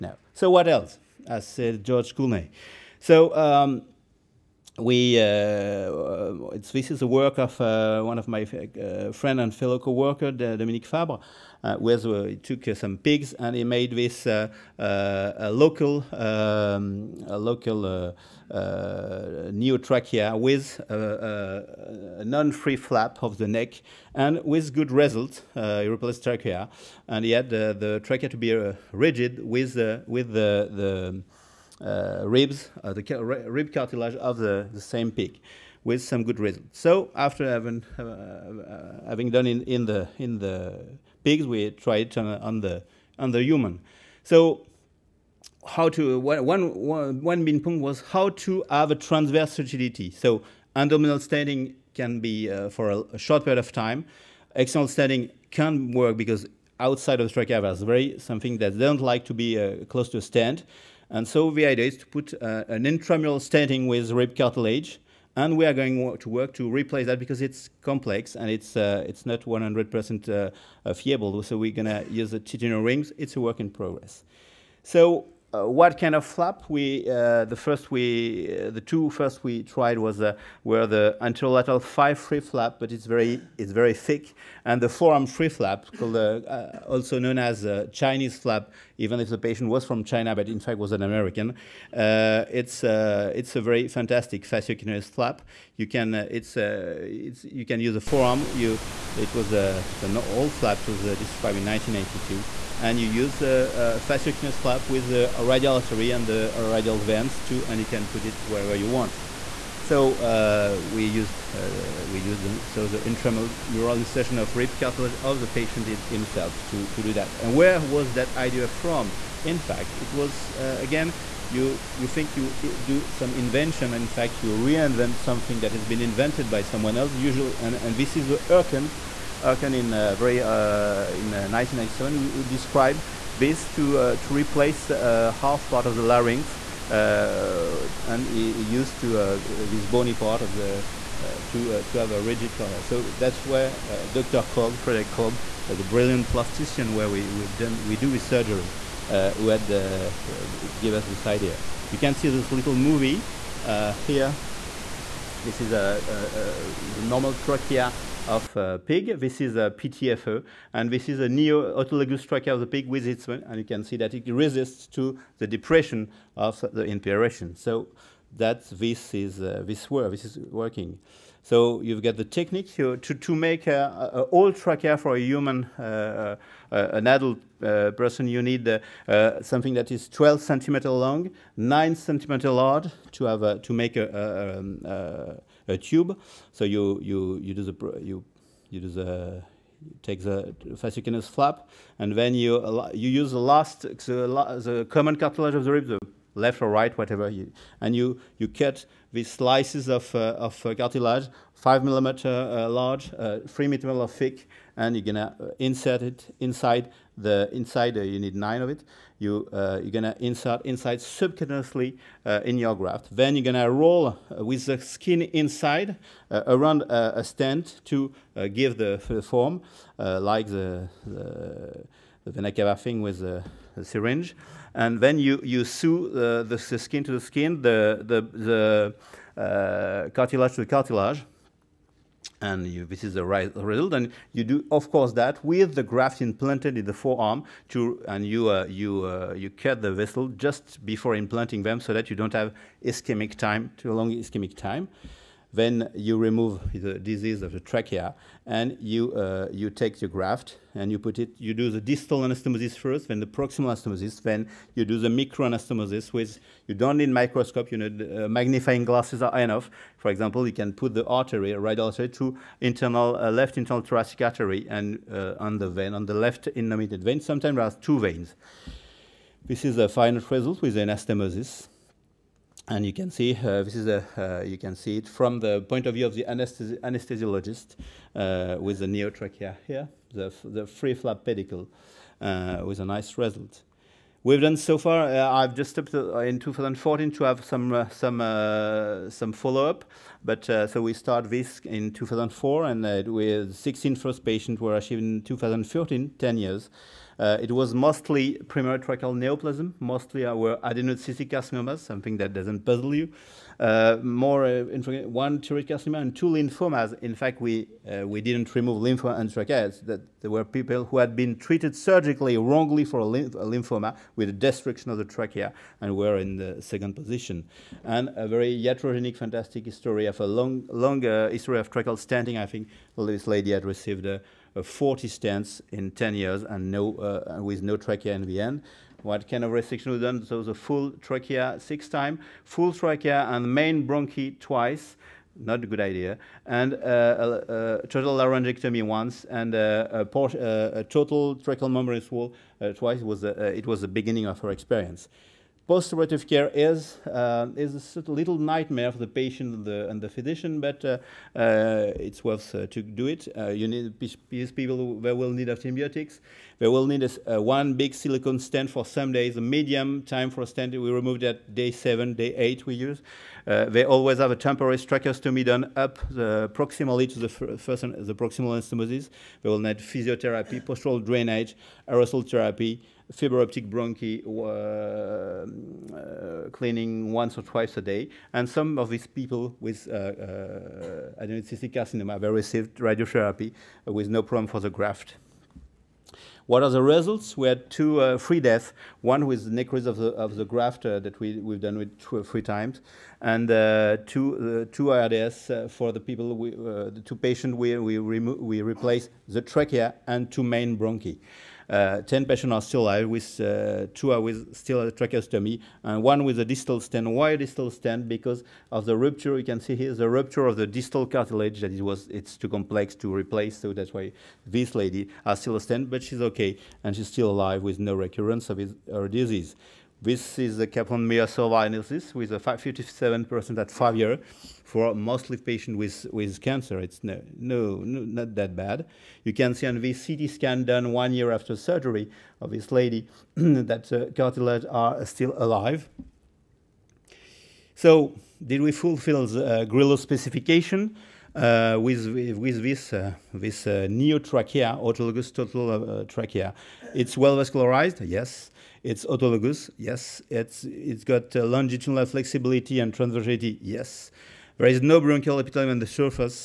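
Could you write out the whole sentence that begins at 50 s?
So abdominal standing can be uh, for a, a, short period of time.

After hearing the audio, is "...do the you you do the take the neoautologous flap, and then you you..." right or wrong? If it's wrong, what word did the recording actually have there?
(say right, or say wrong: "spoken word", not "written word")
wrong: "fasciocutaneous", not "neoautologous".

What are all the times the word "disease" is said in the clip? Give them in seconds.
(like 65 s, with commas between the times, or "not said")
246 s, 419 s.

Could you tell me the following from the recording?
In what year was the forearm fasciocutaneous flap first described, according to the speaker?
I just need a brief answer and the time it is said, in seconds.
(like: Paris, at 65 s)
1982, at 101 s.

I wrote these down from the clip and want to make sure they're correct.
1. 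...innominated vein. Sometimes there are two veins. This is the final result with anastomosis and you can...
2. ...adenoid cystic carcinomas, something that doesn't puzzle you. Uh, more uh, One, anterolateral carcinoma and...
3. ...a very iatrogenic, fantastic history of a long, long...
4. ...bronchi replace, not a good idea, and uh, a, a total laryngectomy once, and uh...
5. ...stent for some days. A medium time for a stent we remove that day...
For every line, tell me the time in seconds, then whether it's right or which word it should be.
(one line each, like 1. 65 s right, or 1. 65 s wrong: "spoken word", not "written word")
1. 266 s right
2. 300 s wrong: "tracheal", not "anterolateral"
3. 318 s right
4. 333 s wrong: "twice", not "replace"
5. 358 s right.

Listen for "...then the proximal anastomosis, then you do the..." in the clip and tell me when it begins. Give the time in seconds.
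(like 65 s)
253 s.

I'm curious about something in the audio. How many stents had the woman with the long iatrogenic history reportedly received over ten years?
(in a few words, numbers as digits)
40.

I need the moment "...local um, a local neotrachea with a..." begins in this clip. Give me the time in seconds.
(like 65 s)
15 s.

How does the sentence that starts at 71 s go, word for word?
So we're going to use the titanium rings.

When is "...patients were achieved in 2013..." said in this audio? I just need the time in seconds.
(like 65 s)
294 s.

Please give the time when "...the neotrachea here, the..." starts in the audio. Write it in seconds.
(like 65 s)
278 s.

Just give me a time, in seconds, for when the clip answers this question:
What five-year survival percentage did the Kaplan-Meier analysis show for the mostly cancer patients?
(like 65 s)
422 s.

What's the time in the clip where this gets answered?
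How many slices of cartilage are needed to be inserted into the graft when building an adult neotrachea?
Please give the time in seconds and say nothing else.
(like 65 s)
208 s.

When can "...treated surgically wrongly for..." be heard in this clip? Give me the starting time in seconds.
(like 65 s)
311 s.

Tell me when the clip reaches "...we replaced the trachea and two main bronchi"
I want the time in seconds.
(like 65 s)
397 s.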